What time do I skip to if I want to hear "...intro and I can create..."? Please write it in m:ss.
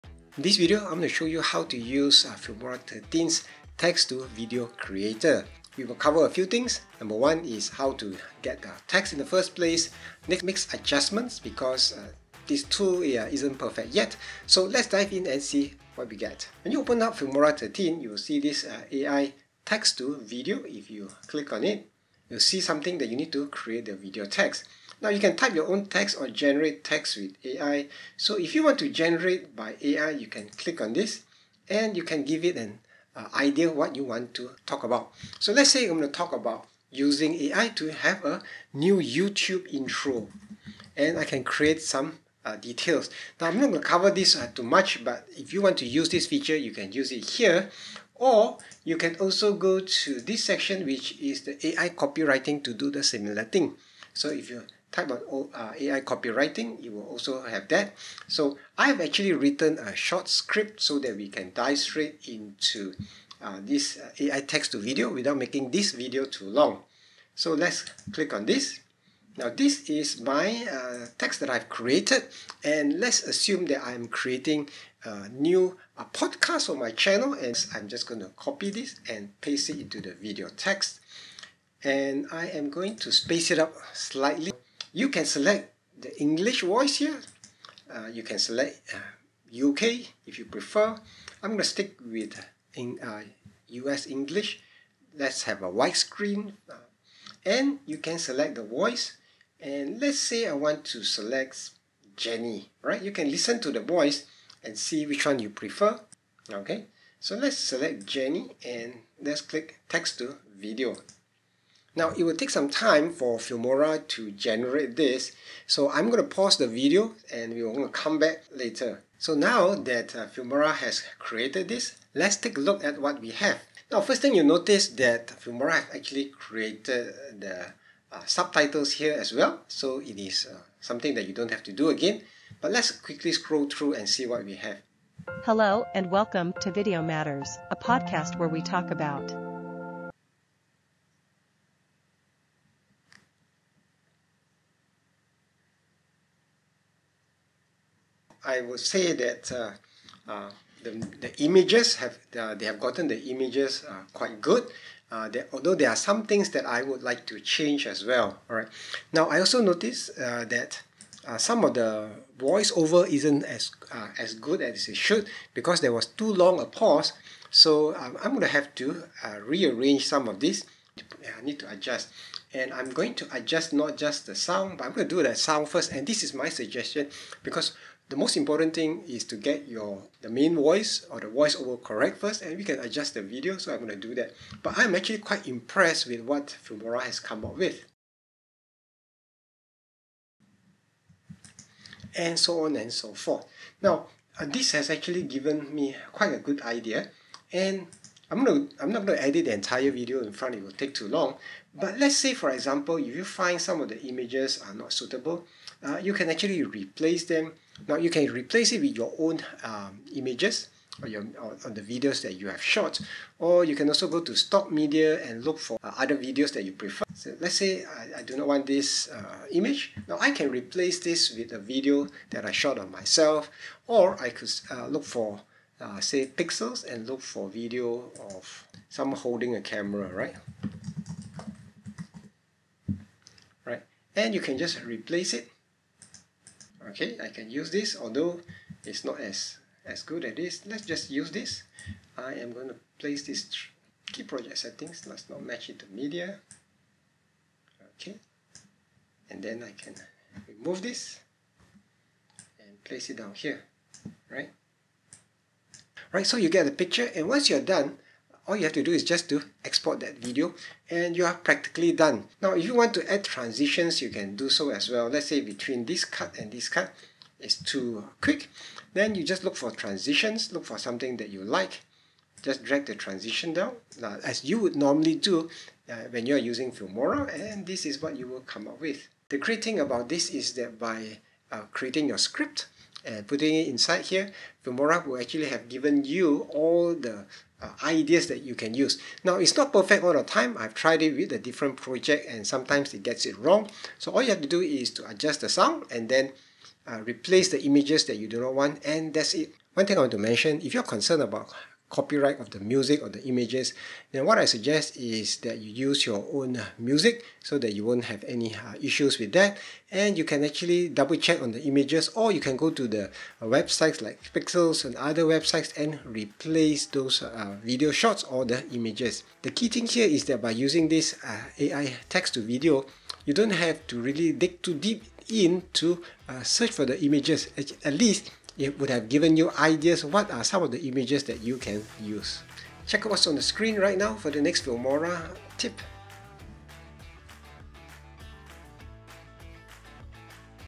0:39.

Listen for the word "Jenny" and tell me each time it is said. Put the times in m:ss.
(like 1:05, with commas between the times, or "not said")
1:42, 1:48.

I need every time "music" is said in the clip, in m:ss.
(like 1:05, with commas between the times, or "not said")
5:02, 5:06.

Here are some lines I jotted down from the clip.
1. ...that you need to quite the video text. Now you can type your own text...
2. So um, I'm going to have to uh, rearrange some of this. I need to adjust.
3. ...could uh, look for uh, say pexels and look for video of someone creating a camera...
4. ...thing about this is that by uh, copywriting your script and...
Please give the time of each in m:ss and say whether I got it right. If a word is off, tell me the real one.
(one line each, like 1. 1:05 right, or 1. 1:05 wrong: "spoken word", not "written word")
1. 0:22 wrong: "create", not "quite"
2. 2:47 right
3. 3:44 wrong: "holding", not "creating"
4. 4:39 wrong: "creating", not "copywriting".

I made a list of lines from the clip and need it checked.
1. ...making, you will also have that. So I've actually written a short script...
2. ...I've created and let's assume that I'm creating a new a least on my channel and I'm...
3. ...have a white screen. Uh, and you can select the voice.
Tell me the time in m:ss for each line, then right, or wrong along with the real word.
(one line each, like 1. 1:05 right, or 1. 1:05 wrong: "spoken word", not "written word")
1. 0:56 wrong: "copywriting", not "making"
2. 1:11 wrong: "podcast", not "least"
3. 1:35 right.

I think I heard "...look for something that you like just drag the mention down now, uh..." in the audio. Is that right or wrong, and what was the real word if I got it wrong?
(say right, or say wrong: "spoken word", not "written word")
wrong: "transition", not "mention".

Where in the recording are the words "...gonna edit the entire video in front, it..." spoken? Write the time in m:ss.
3:19.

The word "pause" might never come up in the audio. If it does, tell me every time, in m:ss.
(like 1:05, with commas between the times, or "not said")
1:56, 2:46.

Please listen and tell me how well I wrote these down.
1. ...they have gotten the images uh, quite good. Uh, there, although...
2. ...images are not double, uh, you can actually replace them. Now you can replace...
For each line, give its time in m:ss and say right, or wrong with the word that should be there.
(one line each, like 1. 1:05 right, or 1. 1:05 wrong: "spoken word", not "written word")
1. 2:32 right
2. 3:24 wrong: "suitable", not "double".